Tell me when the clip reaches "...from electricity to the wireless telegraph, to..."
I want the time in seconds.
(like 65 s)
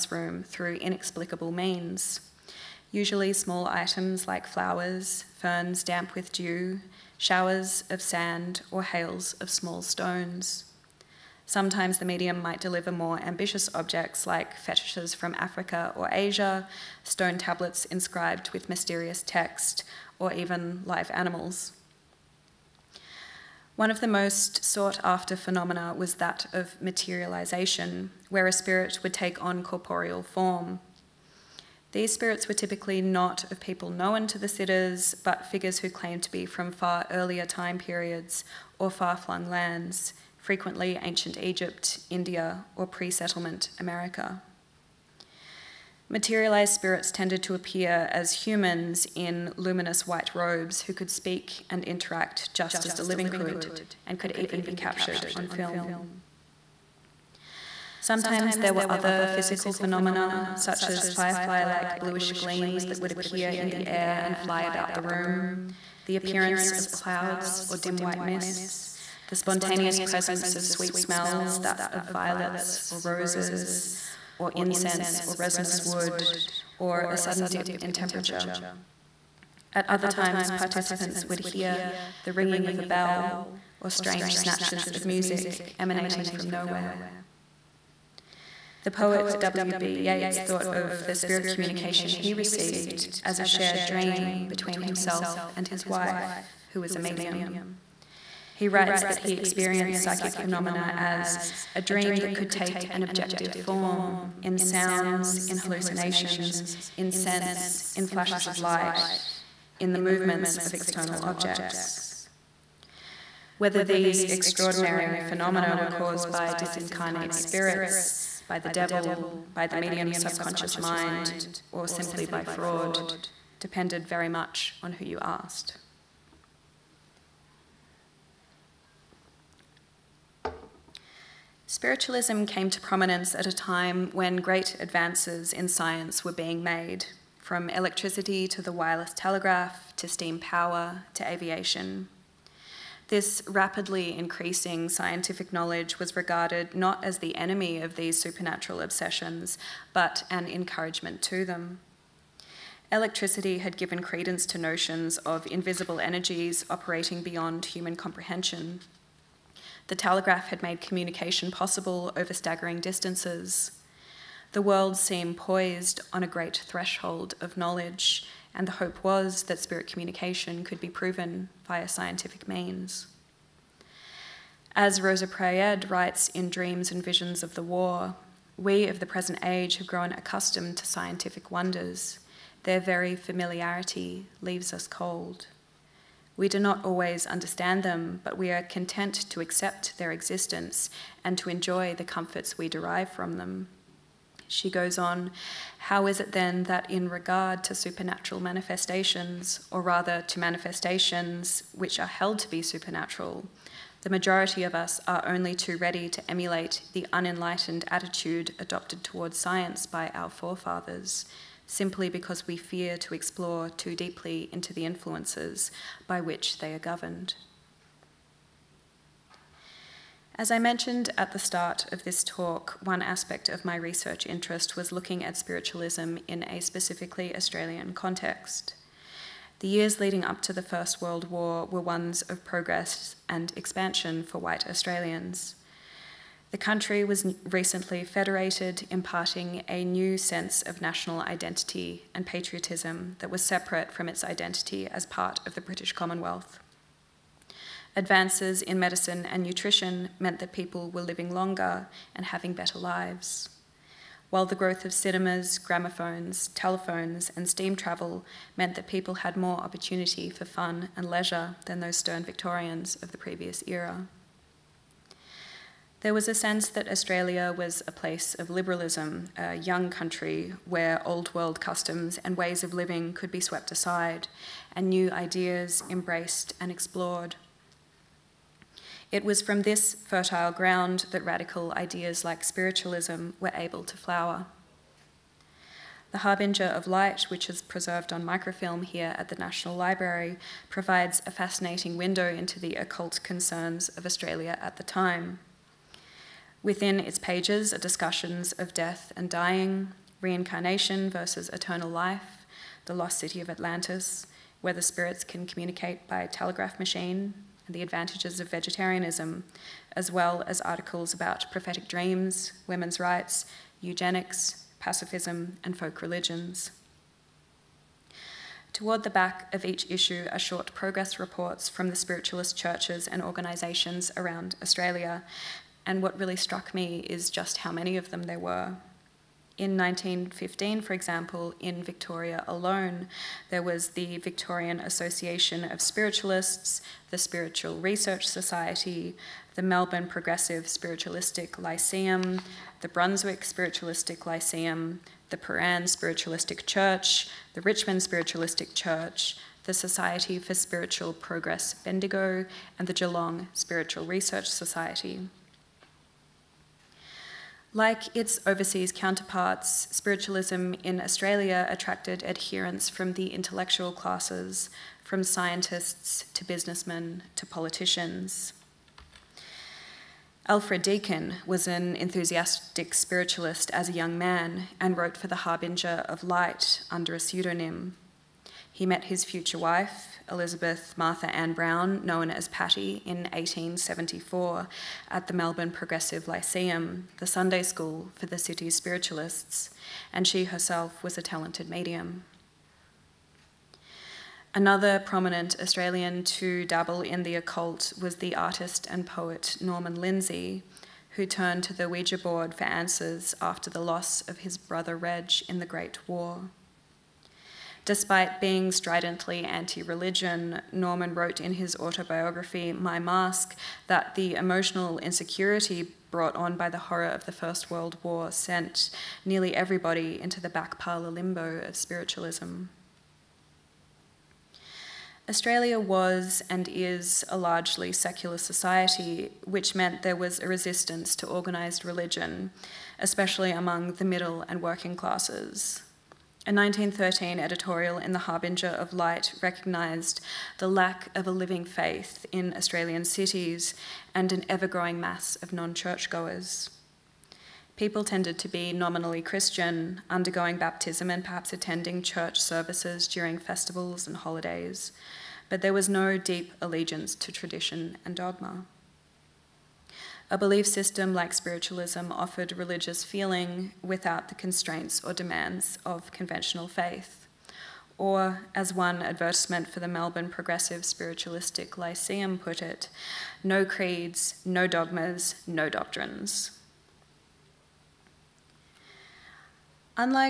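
137 s.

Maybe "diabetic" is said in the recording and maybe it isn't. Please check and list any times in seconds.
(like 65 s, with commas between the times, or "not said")
not said.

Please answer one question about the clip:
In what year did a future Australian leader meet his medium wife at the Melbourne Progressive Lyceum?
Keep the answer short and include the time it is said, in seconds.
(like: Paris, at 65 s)
1874, at 383 s.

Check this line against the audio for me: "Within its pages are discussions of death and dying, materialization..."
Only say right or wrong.
wrong.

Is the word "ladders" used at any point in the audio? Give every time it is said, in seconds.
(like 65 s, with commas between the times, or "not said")
not said.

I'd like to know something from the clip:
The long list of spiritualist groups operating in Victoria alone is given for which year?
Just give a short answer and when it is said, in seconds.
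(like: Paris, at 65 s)
1915, at 329 s.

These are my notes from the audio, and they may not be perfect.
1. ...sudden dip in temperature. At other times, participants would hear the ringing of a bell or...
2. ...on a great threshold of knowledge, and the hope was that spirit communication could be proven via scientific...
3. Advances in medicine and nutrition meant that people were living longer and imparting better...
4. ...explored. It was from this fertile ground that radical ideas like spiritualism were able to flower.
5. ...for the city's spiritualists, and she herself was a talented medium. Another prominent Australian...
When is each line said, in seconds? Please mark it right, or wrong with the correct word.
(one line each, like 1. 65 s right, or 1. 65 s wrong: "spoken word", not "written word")
1. 77 s right
2. 166 s right
3. 247 s wrong: "having", not "imparting"
4. 276 s right
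5. 388 s right.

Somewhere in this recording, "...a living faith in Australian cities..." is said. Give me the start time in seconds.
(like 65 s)
441 s.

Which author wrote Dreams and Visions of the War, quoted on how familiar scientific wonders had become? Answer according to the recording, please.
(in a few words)
Rosa Praed.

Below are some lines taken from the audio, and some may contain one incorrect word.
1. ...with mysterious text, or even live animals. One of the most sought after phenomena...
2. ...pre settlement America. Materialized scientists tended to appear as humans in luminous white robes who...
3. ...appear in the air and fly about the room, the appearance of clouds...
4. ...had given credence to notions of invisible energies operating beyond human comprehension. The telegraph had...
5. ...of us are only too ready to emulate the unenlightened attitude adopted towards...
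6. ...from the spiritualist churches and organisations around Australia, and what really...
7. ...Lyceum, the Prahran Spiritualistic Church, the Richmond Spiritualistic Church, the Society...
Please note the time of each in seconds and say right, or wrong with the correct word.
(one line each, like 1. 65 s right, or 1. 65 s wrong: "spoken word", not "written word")
1. 18 s right
2. 42 s wrong: "spirits", not "scientists"
3. 63 s right
4. 153 s right
5. 204 s right
6. 321 s right
7. 344 s right.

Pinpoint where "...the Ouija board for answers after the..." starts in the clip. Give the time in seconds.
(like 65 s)
401 s.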